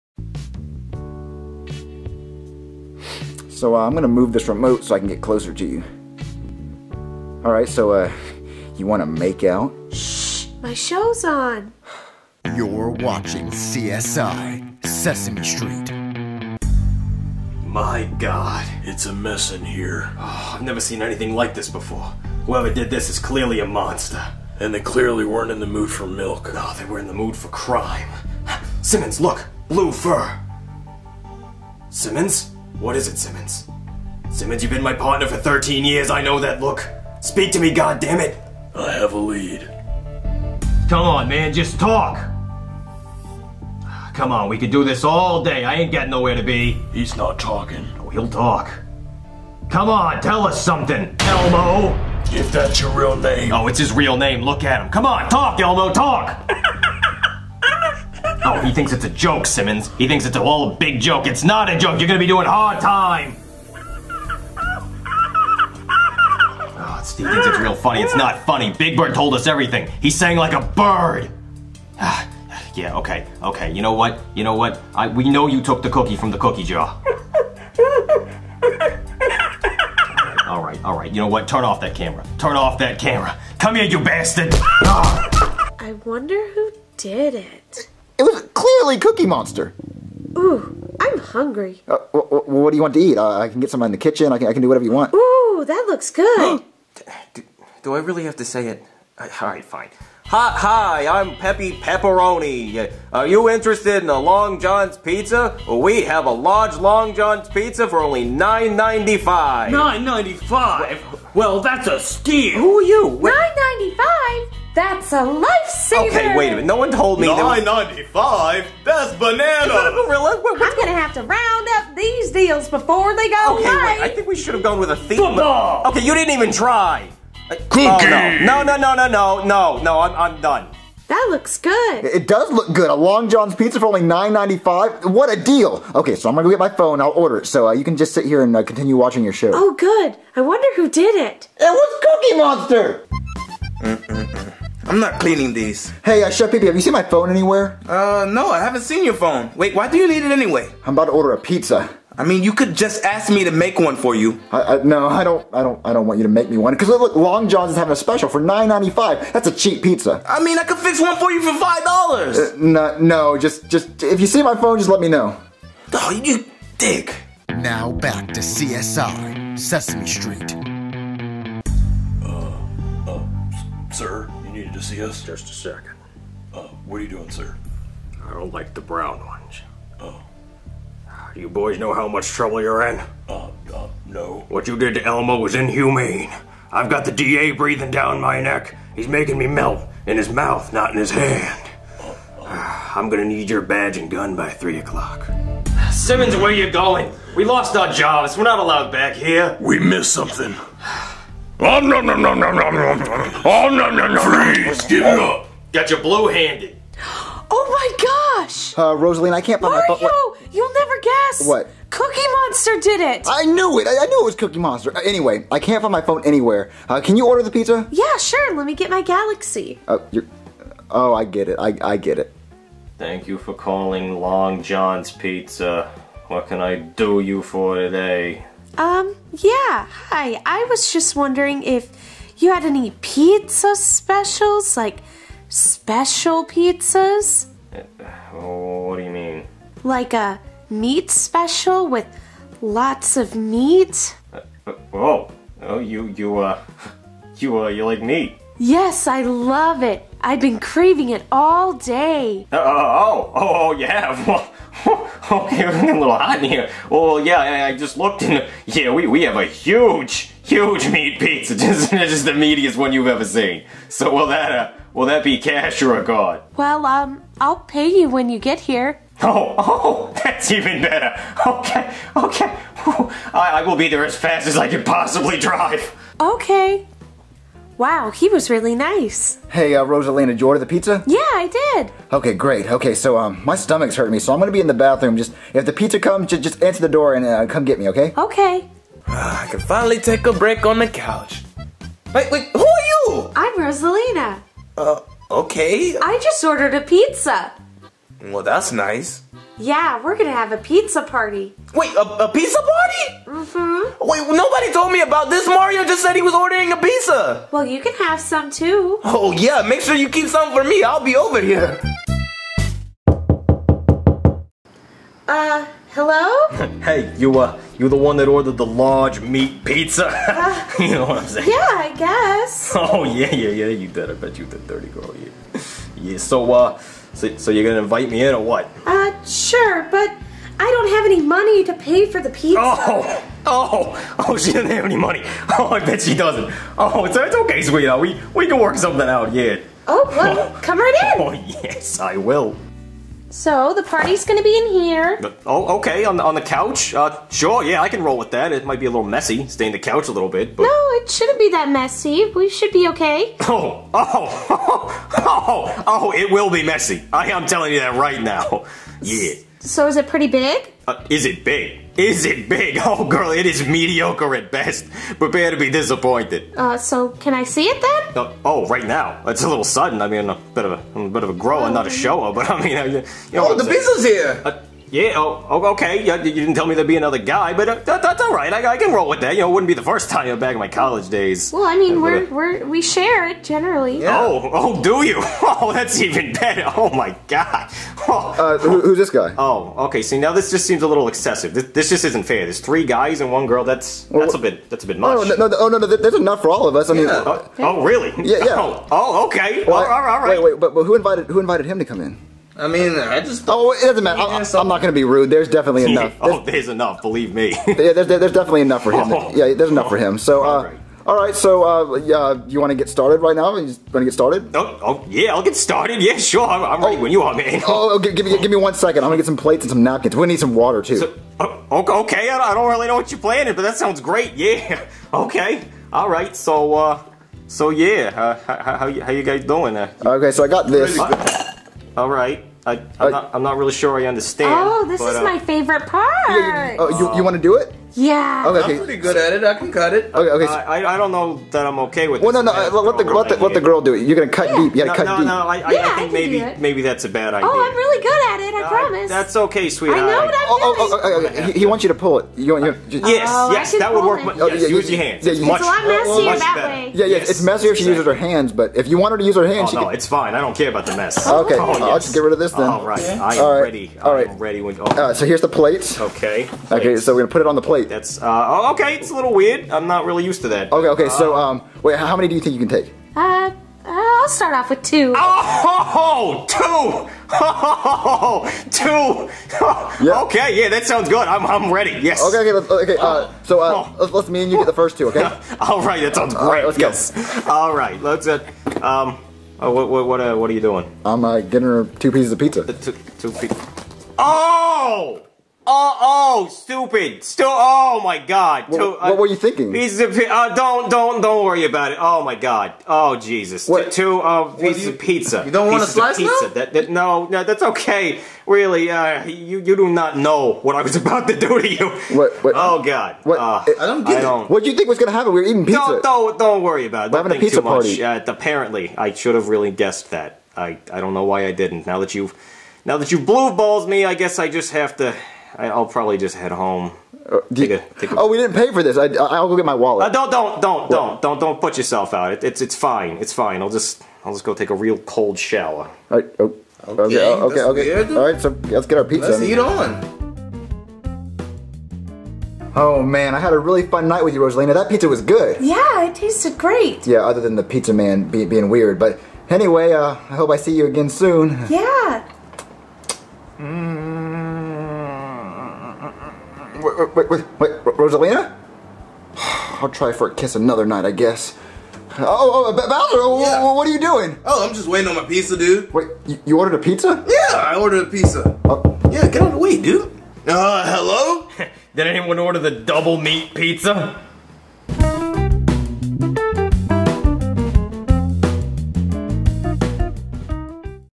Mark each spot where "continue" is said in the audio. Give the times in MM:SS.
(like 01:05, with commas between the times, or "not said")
02:18.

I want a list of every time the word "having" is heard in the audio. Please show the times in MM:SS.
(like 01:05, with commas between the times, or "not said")
02:37, 08:37.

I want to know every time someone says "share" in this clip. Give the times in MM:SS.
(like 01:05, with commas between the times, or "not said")
06:22.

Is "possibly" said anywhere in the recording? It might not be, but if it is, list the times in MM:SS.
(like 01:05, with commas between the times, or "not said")
04:34.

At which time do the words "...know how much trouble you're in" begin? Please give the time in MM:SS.
03:01.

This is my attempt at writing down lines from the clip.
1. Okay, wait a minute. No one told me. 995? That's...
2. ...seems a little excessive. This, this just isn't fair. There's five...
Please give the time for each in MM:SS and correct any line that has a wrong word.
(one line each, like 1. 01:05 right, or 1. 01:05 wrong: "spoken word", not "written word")
1. 01:56 right
2. 06:30 wrong: "three", not "five".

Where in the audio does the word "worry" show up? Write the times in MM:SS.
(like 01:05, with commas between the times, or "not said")
08:21, 08:36.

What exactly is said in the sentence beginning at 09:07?
Yeah, other than the pizza man be, being weird.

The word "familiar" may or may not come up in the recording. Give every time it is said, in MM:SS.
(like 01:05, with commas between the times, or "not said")
not said.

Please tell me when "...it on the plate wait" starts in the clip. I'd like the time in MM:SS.
07:47.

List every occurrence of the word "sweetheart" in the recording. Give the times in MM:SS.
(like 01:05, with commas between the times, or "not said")
05:37, 07:29.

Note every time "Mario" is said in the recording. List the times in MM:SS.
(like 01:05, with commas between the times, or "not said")
03:29, 05:05.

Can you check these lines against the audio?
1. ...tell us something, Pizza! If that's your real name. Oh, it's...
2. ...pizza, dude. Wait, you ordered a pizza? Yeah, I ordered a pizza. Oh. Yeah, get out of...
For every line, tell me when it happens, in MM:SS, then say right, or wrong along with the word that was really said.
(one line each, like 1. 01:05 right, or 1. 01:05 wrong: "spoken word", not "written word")
1. 00:50 wrong: "Elmo", not "Pizza"
2. 09:25 right.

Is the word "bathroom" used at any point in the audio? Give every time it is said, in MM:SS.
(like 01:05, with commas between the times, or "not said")
04:44.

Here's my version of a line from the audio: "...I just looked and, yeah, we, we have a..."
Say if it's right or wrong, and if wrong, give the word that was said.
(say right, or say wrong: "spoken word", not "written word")
right.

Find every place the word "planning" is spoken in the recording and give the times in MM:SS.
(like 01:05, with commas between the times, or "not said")
07:03.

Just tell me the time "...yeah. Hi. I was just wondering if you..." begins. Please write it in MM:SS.
03:49.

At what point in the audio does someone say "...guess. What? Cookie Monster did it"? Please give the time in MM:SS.
03:31.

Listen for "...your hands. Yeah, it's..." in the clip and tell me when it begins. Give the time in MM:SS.
07:34.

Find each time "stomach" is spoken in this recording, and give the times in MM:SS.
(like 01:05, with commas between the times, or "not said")
04:43.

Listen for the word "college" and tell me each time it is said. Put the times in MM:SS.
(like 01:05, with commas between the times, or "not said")
06:20.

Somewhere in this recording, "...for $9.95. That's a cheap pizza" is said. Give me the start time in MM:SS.
02:38.